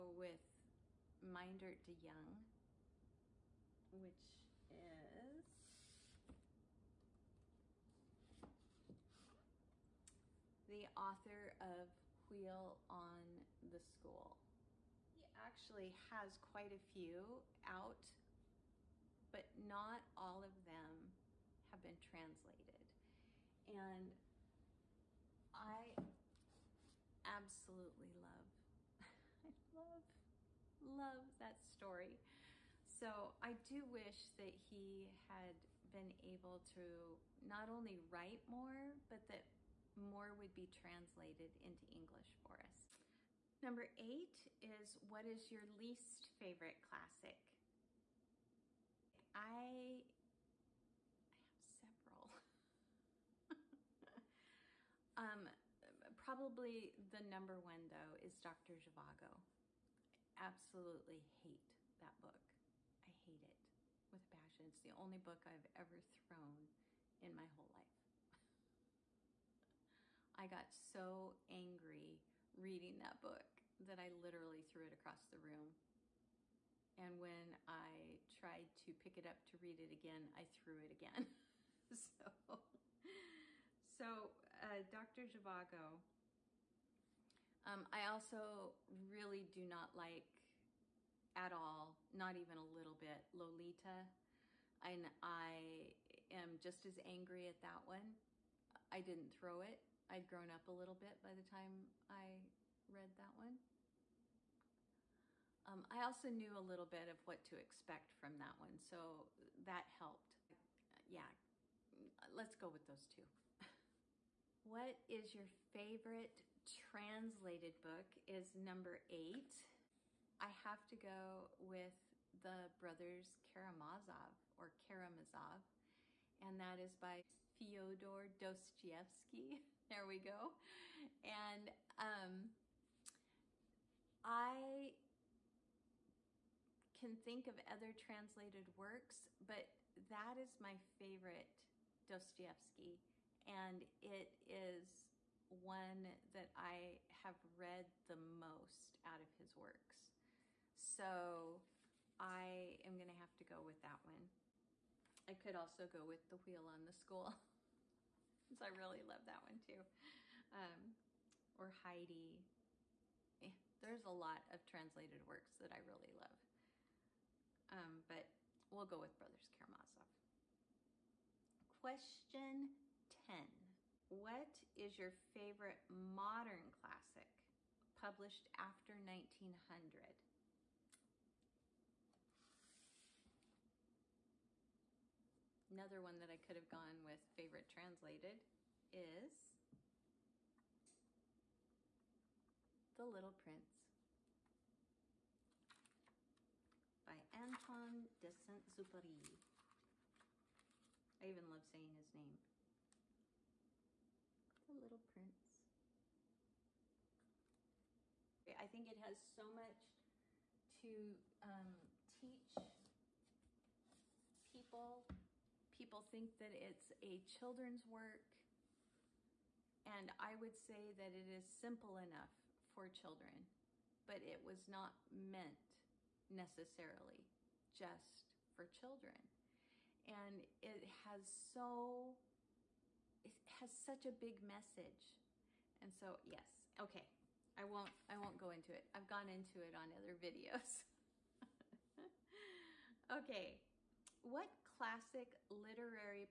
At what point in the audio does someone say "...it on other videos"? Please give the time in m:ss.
3:59.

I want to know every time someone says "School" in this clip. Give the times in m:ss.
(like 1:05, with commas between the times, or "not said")
0:13, 2:36.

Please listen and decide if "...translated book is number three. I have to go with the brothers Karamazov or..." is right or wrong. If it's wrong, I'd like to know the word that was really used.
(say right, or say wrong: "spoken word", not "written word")
wrong: "eight", not "three".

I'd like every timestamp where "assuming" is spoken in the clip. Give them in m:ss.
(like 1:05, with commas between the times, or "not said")
not said.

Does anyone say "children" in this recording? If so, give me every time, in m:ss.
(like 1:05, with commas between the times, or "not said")
3:37, 3:42, 3:48.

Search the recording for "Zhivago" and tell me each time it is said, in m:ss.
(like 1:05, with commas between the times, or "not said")
0:58, 1:25.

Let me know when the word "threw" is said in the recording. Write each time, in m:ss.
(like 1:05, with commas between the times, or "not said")
1:14, 1:20.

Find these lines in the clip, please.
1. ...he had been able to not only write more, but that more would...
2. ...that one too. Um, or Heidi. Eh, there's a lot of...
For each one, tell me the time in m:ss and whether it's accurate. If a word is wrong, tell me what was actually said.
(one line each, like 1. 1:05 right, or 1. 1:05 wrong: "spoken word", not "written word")
1. 0:34 right
2. 2:39 right.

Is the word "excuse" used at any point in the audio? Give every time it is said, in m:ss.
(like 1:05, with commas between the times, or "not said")
not said.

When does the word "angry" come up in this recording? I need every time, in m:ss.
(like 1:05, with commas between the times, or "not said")
1:11, 1:37.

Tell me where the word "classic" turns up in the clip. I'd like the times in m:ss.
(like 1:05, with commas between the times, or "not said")
0:46, 2:56, 4:04.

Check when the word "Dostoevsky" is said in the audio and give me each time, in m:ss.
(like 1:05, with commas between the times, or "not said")
2:08, 2:22.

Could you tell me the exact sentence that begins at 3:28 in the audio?
I think it has so much to um, teach people.